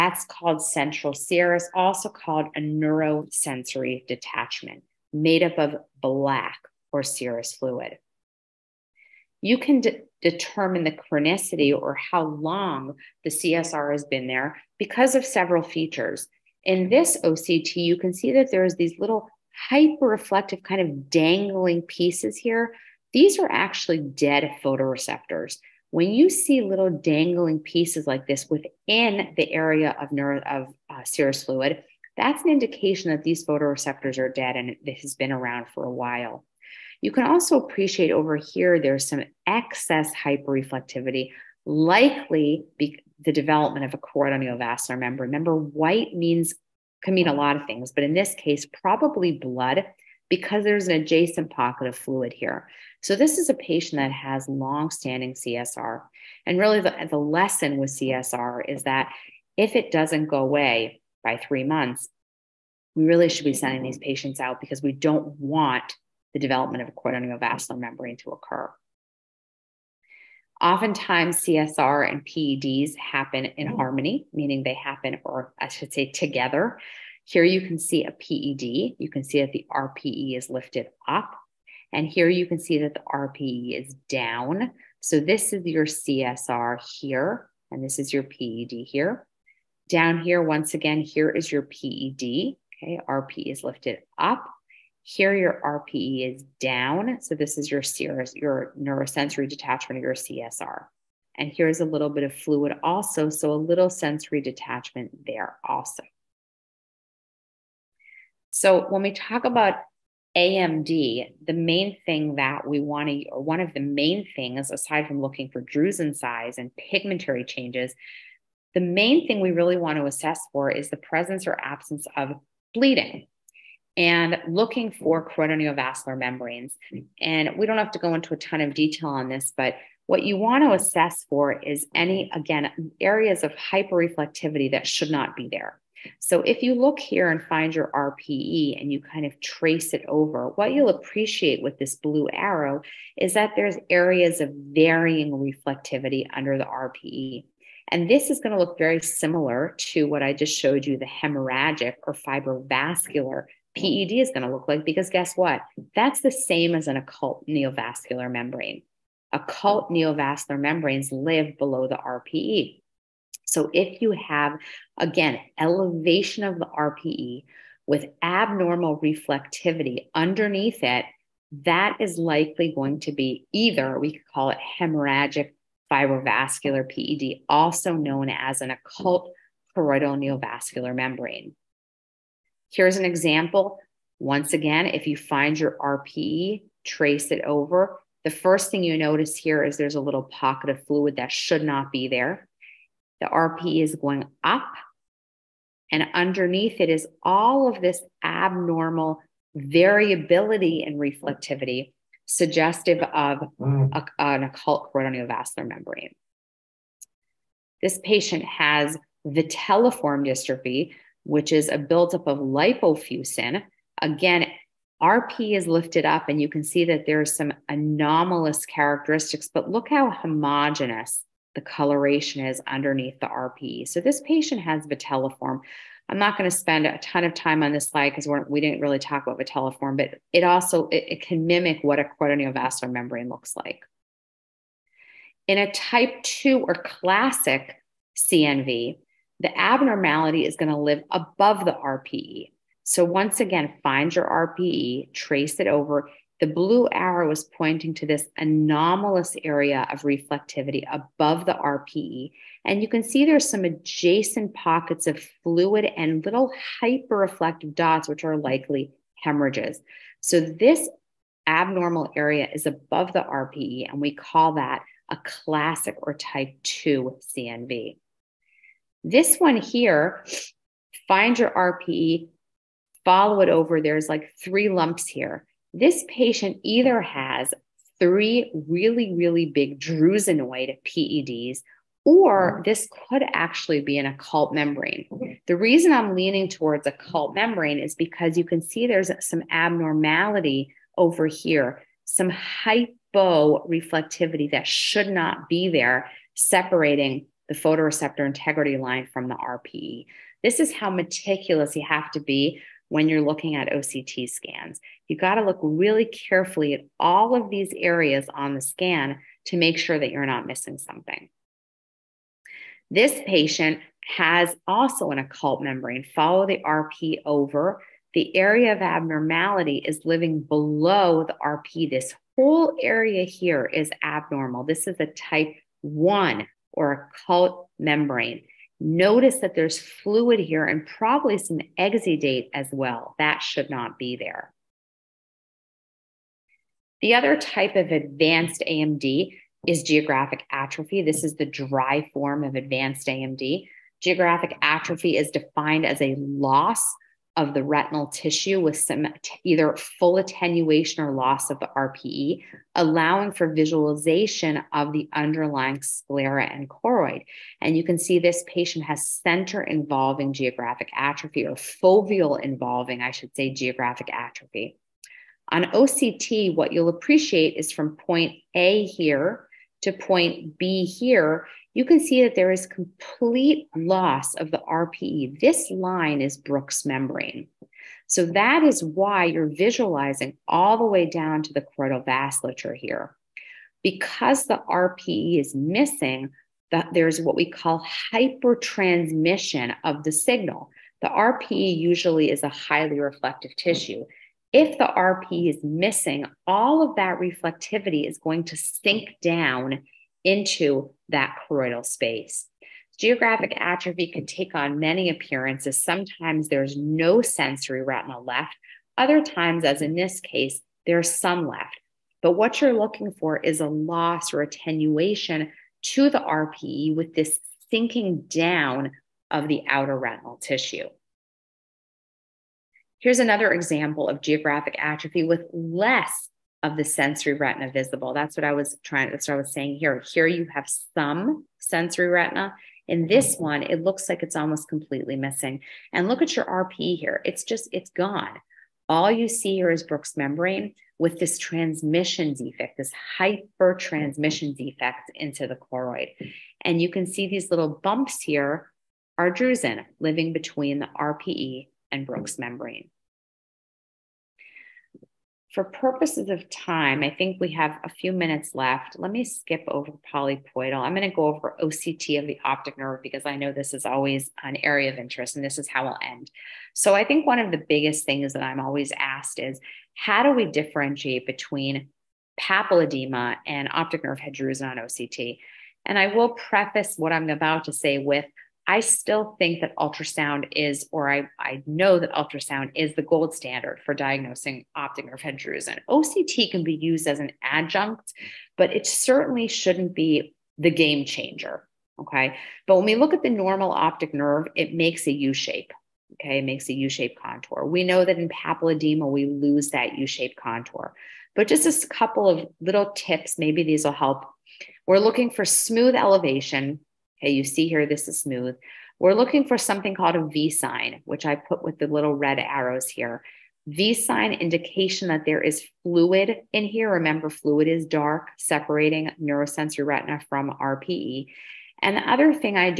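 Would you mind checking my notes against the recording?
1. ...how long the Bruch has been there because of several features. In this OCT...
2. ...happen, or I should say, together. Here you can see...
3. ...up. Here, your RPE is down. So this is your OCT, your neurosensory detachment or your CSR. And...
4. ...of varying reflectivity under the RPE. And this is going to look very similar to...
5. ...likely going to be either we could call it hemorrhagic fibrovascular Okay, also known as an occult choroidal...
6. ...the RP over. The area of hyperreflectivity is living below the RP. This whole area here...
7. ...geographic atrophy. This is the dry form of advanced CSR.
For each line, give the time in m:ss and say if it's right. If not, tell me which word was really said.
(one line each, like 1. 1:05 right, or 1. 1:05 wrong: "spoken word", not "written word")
1. 0:11 wrong: "CSR", not "Bruch"
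2. 1:14 right
3. 1:34 wrong: "CRS", not "OCT"
4. 2:24 right
5. 2:52 wrong: "PED", not "Okay"
6. 5:16 wrong: "abnormality", not "hyperreflectivity"
7. 5:39 wrong: "AMD", not "CSR".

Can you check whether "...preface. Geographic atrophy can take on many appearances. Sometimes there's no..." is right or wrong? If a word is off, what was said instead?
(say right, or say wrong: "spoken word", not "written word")
wrong: "space", not "preface".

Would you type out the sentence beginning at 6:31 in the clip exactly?
The RPE usually is a highly reflective tissue.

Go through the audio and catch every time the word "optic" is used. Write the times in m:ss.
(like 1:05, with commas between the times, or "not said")
7:42, 7:53, 8:04, 8:13.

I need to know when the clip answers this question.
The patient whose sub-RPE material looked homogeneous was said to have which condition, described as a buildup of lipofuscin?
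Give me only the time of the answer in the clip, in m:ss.
3:29.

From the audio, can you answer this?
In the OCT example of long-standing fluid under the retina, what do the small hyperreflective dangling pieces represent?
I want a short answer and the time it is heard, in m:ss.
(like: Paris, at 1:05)
Dead photoreceptors, at 0:23.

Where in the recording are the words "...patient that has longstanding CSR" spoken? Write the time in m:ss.
0:53.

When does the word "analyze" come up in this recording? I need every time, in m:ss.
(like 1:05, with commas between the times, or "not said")
not said.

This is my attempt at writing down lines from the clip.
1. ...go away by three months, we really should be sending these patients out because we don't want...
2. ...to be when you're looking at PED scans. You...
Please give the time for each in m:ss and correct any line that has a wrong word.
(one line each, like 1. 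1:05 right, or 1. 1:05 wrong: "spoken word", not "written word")
1. 1:00 right
2. 5:02 wrong: "OCT", not "PED".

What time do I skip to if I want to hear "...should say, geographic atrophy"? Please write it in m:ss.
6:03.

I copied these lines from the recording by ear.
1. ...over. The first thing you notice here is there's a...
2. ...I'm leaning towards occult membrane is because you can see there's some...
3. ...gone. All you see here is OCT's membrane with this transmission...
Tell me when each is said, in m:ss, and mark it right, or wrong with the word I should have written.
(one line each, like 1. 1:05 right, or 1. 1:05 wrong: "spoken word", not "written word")
1. 3:07 right
2. 4:45 right
3. 7:17 wrong: "Bruch", not "OCT".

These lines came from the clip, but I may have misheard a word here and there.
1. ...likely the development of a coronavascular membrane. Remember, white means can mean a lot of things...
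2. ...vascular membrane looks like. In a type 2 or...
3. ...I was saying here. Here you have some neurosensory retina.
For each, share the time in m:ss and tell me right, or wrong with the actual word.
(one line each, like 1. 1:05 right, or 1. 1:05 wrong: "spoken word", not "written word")
1. 0:41 right
2. 3:52 right
3. 7:09 wrong: "sensory", not "neurosensory".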